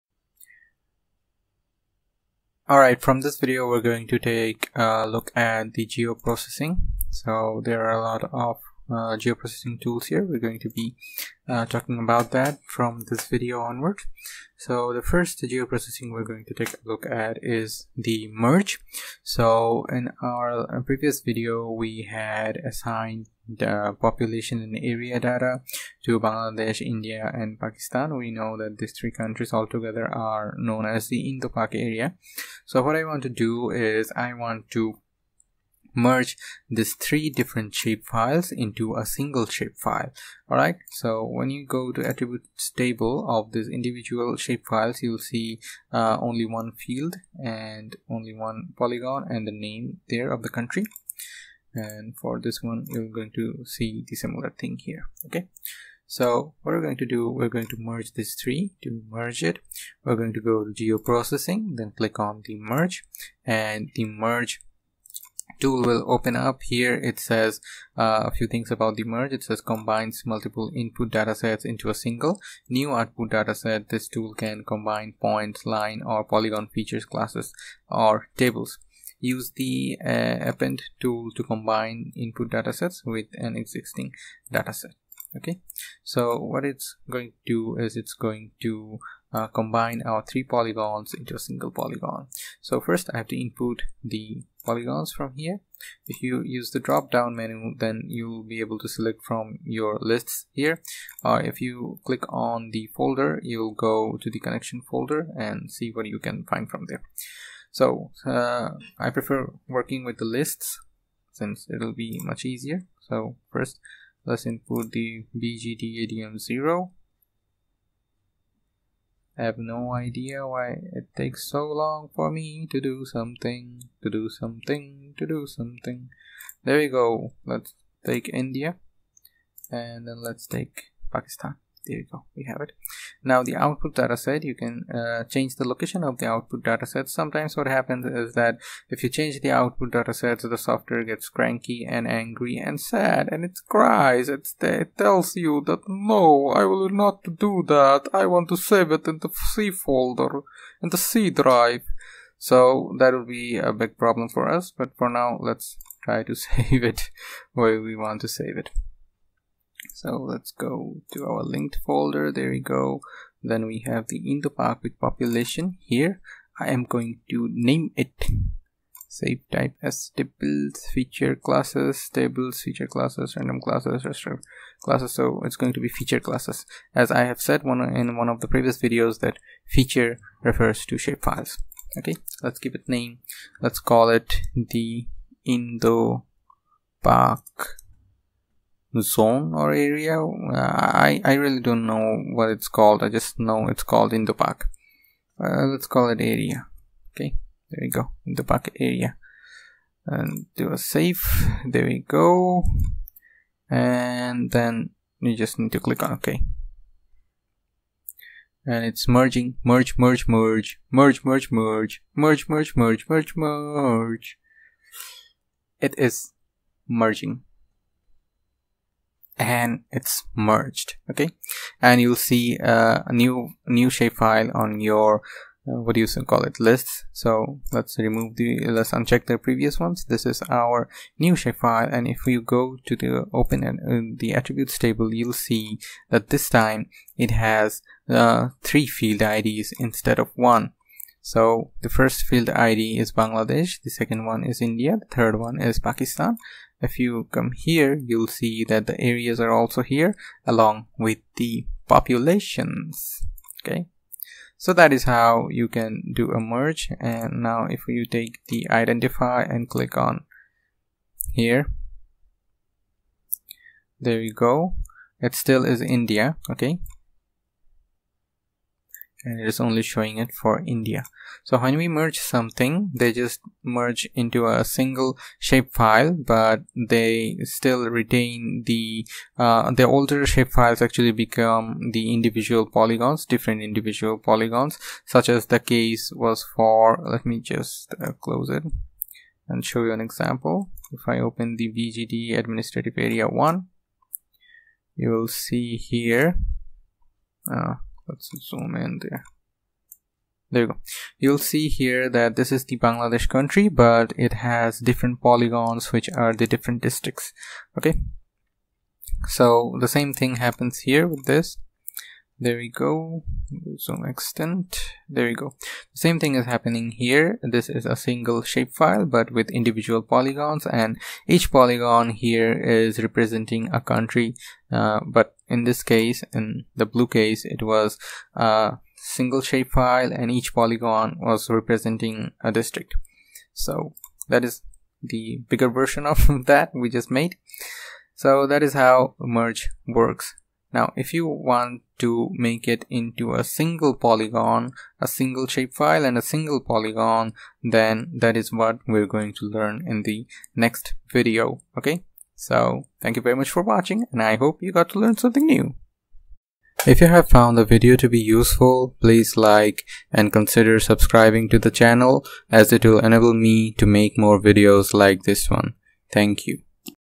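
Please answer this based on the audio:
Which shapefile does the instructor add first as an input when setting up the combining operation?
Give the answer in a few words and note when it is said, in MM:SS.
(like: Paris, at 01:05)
bgdadm0, at 01:55.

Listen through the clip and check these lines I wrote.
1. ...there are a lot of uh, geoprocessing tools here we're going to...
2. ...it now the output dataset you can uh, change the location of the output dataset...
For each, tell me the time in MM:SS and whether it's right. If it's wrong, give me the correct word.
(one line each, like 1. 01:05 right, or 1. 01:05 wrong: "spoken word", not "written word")
1. 00:07 right
2. 02:12 right.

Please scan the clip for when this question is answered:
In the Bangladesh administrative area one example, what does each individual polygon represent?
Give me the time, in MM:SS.
05:32.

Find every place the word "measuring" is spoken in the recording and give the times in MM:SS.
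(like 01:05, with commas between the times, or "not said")
not said.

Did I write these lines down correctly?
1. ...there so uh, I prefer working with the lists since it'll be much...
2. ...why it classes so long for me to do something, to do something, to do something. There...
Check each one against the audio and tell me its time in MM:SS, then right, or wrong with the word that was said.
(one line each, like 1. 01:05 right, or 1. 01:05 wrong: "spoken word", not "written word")
1. 01:46 right
2. 02:00 wrong: "takes", not "classes".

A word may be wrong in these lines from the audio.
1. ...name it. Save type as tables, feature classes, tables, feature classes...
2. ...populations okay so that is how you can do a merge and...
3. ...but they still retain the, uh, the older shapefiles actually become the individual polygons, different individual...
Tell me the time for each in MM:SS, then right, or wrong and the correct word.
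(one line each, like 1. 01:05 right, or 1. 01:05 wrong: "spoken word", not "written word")
1. 02:47 right
2. 04:11 right
3. 04:36 right.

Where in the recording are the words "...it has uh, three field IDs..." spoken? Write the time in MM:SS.
03:57.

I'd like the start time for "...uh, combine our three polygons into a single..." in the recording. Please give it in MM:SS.
01:29.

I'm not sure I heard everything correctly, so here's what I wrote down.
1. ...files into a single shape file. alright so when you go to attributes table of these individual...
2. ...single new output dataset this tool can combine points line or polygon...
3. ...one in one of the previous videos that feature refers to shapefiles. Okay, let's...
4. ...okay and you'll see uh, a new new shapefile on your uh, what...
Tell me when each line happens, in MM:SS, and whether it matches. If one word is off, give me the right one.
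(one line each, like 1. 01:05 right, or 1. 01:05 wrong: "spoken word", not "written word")
1. 00:38 right
2. 01:11 right
3. 02:57 right
4. 03:41 right.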